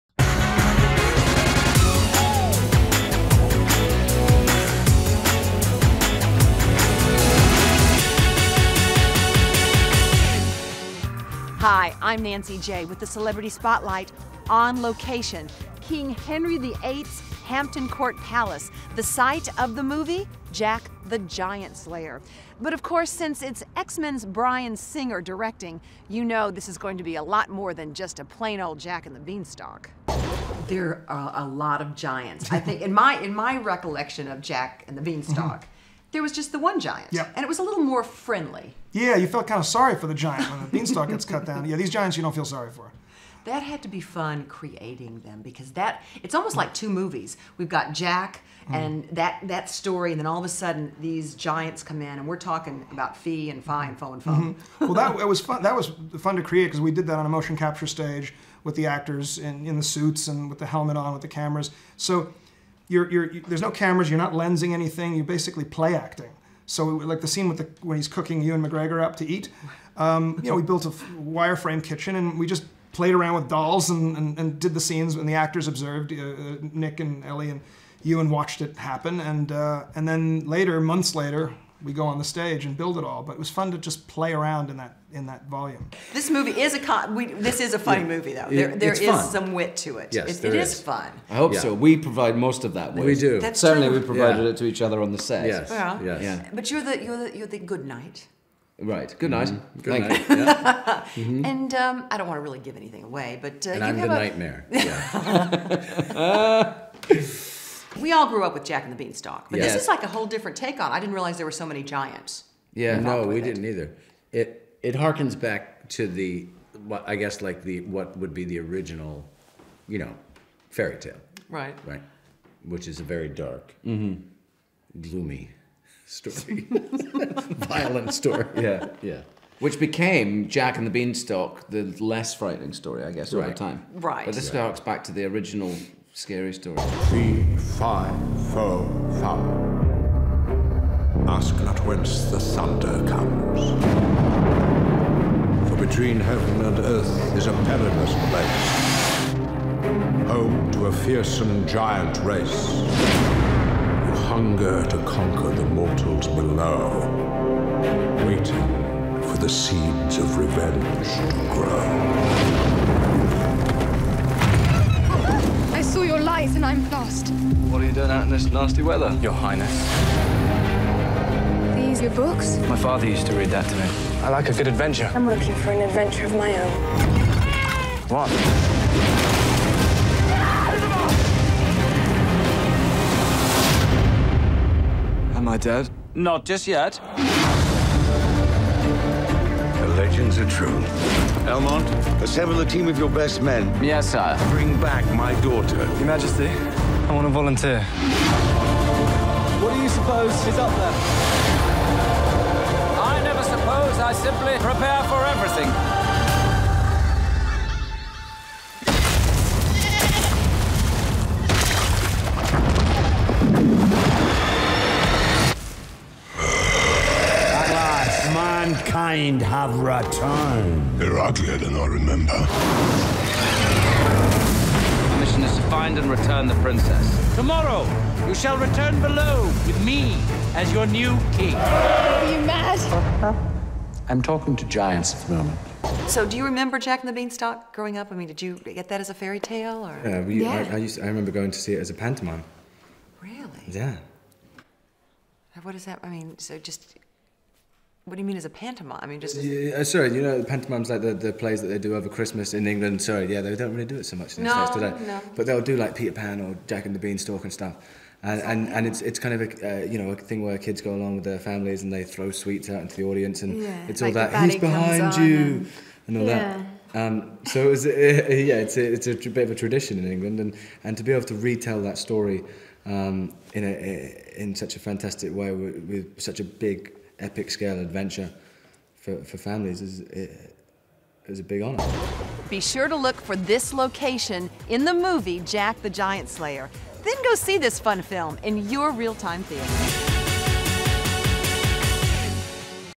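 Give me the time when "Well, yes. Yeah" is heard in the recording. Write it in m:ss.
1:35.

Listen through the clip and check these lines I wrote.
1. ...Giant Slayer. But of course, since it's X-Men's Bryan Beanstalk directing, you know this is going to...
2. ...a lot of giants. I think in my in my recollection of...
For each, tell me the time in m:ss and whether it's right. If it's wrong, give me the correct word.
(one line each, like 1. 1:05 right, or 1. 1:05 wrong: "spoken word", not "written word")
1. 0:21 wrong: "Singer", not "Beanstalk"
2. 0:31 right.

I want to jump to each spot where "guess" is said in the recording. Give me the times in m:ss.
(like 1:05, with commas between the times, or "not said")
1:57, 2:13.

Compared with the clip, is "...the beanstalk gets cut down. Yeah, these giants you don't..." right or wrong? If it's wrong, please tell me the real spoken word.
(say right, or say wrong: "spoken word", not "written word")
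right.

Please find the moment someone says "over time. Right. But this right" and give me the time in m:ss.
2:13.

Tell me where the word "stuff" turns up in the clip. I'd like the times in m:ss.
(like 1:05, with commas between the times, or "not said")
4:17.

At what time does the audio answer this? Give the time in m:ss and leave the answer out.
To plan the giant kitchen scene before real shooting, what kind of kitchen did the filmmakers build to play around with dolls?
1:10.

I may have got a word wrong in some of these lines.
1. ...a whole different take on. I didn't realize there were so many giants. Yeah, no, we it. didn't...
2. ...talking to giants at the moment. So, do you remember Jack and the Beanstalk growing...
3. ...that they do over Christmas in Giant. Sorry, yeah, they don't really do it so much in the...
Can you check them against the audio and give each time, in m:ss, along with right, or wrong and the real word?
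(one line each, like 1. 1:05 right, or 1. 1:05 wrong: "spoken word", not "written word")
1. 1:50 right
2. 3:54 right
3. 4:11 wrong: "England", not "Giant".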